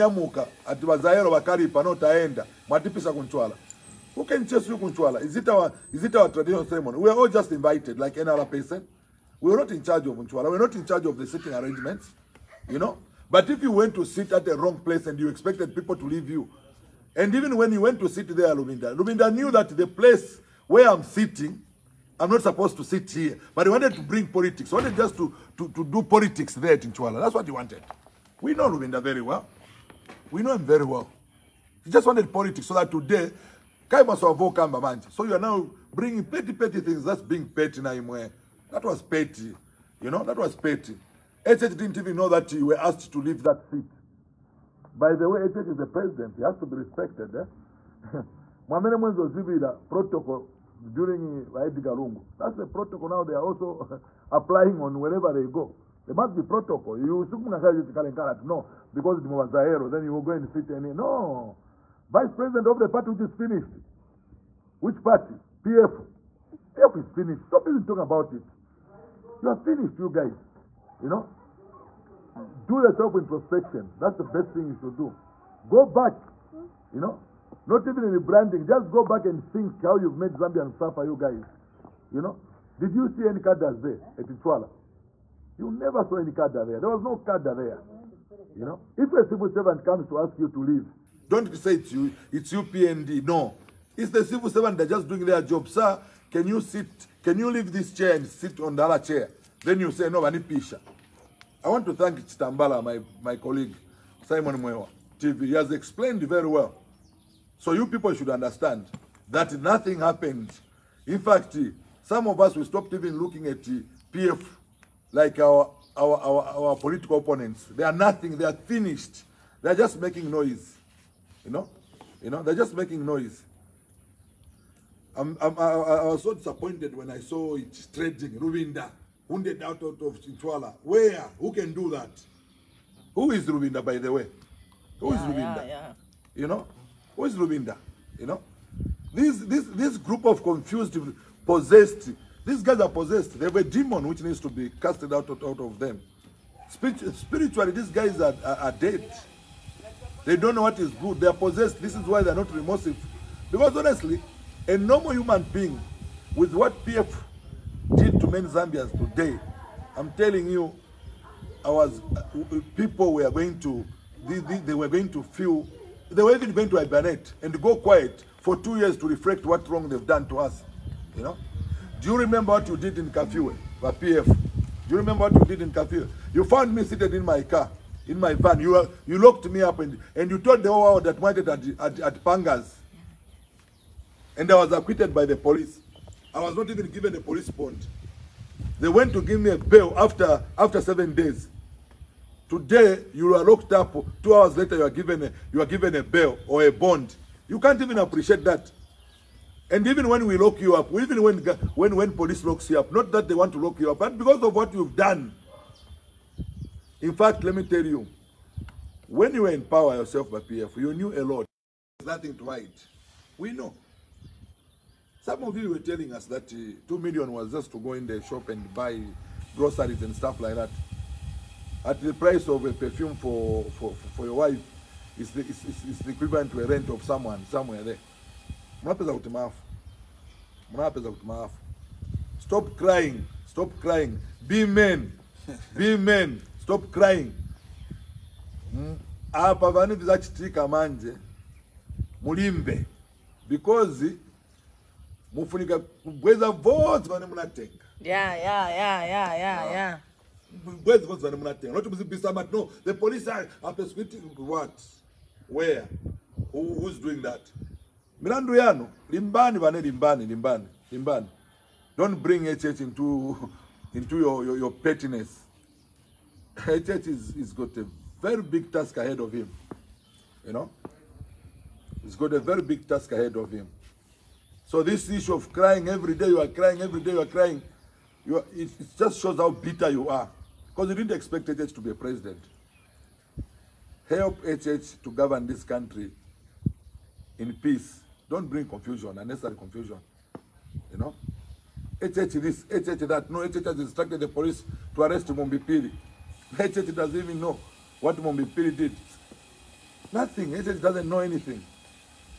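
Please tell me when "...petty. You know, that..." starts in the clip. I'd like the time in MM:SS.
00:39.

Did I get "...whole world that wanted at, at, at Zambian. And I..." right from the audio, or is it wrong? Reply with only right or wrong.
wrong.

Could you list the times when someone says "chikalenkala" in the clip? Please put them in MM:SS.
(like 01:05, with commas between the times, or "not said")
00:57.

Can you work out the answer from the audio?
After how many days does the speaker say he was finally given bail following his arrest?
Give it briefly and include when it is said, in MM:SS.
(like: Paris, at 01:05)
7, at 03:10.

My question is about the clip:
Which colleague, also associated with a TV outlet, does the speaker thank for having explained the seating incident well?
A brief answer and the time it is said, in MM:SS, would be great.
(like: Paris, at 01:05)
Simon Mwewa, at 01:44.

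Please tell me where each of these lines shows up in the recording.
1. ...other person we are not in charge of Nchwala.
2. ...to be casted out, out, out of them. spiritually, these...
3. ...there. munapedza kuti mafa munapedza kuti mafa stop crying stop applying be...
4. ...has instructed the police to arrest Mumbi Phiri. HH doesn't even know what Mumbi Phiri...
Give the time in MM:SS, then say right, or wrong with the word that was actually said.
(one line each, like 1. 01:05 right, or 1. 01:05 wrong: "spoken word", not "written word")
1. 00:08 right
2. 02:24 right
3. 03:47 wrong: "crying", not "applying"
4. 04:53 right.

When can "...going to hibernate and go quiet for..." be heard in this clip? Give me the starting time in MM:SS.
02:46.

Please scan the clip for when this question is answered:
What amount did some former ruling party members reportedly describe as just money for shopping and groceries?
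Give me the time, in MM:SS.
03:36.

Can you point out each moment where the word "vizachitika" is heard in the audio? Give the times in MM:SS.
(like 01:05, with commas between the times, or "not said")
03:59.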